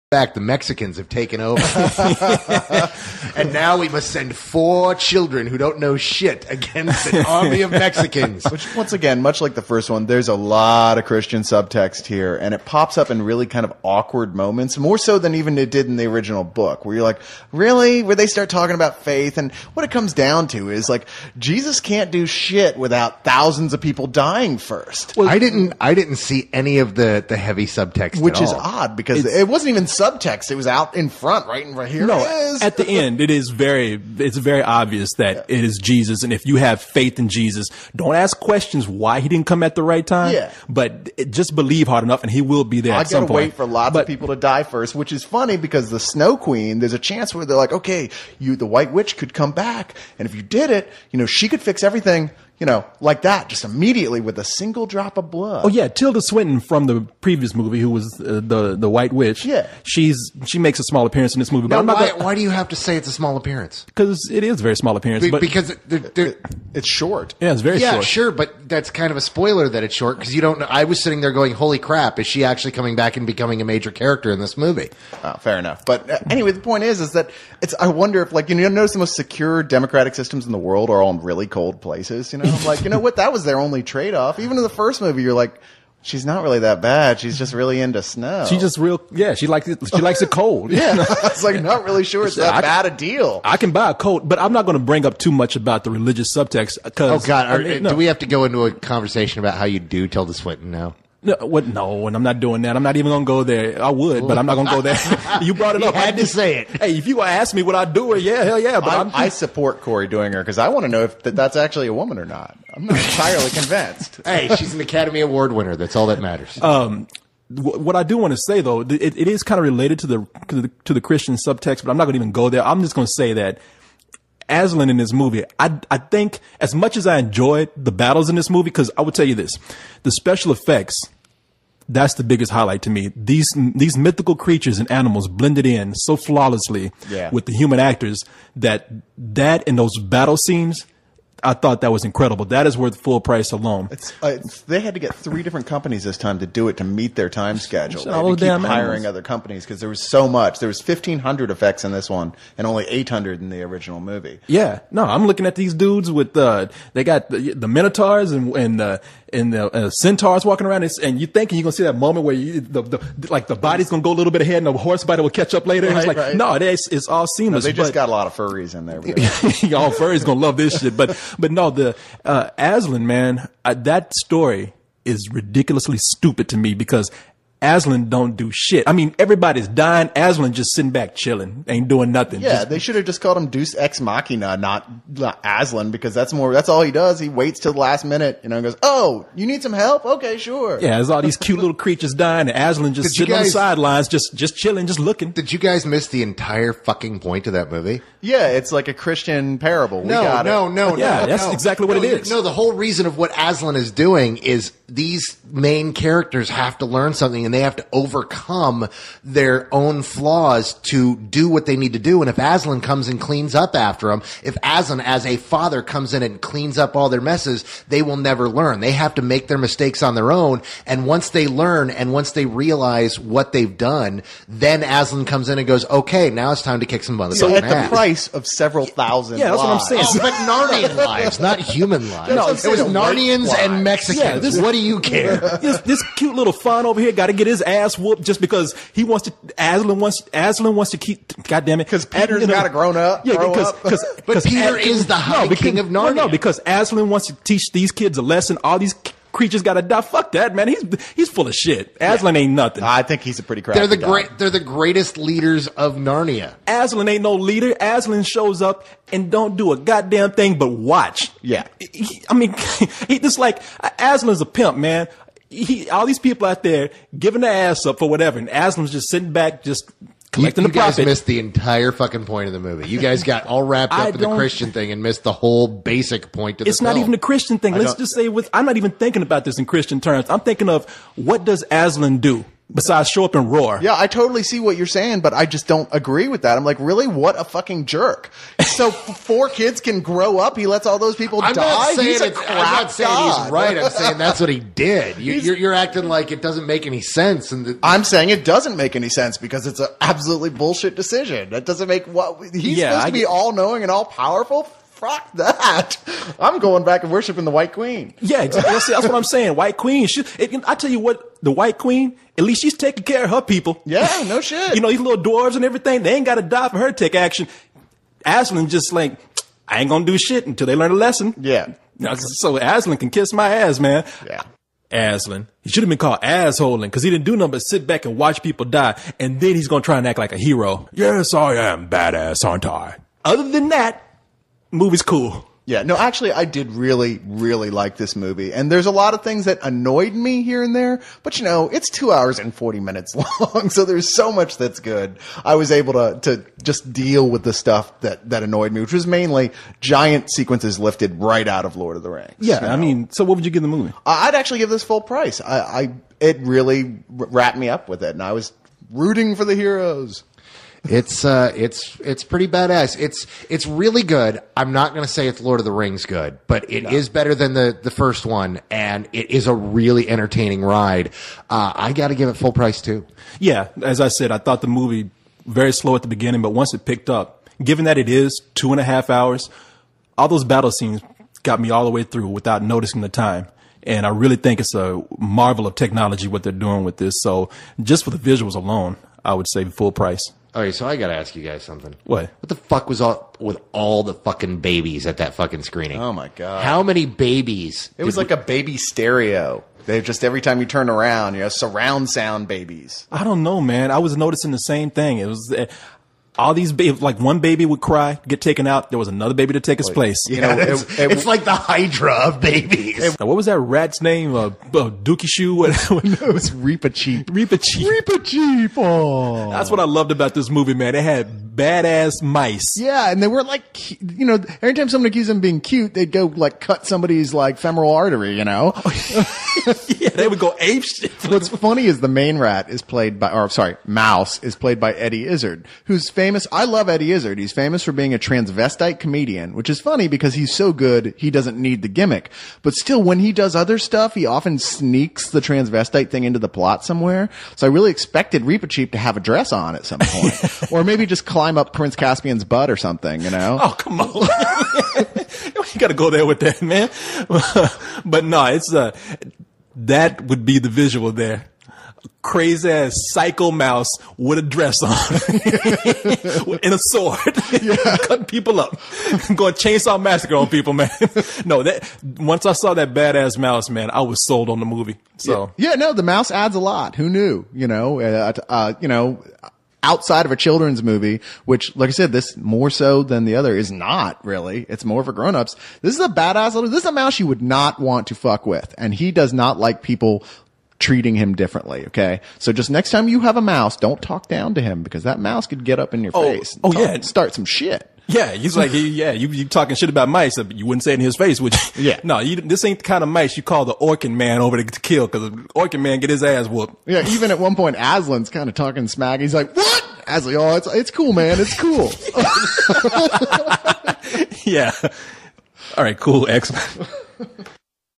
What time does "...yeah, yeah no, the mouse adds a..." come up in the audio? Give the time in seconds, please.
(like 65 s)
475 s.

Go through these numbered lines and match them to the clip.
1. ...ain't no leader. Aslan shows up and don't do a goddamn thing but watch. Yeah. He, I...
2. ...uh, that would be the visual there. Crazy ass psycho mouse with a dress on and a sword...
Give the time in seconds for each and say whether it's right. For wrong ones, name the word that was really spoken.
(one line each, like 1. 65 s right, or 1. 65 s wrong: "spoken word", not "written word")
1. 257 s right
2. 458 s right.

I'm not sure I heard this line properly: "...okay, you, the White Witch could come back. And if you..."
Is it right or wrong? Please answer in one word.
right.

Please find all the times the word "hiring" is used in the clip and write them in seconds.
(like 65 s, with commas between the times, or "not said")
148 s.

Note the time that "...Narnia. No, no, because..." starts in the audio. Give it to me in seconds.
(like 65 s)
245 s.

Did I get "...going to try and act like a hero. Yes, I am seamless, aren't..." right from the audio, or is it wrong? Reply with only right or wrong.
wrong.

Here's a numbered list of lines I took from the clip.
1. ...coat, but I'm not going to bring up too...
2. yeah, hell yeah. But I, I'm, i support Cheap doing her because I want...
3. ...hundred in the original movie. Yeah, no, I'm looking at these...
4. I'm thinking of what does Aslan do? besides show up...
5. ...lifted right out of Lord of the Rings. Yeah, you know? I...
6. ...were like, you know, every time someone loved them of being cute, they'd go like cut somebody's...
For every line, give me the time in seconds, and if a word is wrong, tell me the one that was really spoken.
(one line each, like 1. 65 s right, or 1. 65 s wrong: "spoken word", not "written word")
1. 93 s right
2. 108 s wrong: "Korey", not "Cheap"
3. 153 s right
4. 280 s right
5. 350 s right
6. 423 s wrong: "accused", not "loved".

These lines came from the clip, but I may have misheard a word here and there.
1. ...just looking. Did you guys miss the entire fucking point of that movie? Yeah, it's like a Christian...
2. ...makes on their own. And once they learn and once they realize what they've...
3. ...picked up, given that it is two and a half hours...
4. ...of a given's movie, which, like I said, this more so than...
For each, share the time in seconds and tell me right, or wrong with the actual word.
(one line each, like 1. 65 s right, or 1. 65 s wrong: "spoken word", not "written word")
1. 194 s right
2. 219 s wrong: "mistakes", not "makes"
3. 376 s right
4. 480 s wrong: "children", not "given".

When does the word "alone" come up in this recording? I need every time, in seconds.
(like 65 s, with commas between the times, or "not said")
143 s, 388 s.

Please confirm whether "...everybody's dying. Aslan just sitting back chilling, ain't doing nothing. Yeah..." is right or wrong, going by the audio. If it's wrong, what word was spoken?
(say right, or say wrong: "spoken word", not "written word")
right.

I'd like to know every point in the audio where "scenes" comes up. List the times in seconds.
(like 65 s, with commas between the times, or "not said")
140 s, 380 s.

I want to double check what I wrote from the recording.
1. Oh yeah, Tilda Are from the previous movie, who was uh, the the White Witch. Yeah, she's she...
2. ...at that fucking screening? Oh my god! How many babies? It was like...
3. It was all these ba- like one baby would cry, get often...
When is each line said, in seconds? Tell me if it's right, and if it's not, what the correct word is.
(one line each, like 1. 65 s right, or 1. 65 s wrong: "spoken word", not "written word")
1. 55 s wrong: "Swinton", not "Are"
2. 395 s right
3. 405 s wrong: "taken", not "often".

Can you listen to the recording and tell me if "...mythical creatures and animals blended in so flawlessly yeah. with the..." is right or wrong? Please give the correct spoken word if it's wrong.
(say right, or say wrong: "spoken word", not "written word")
right.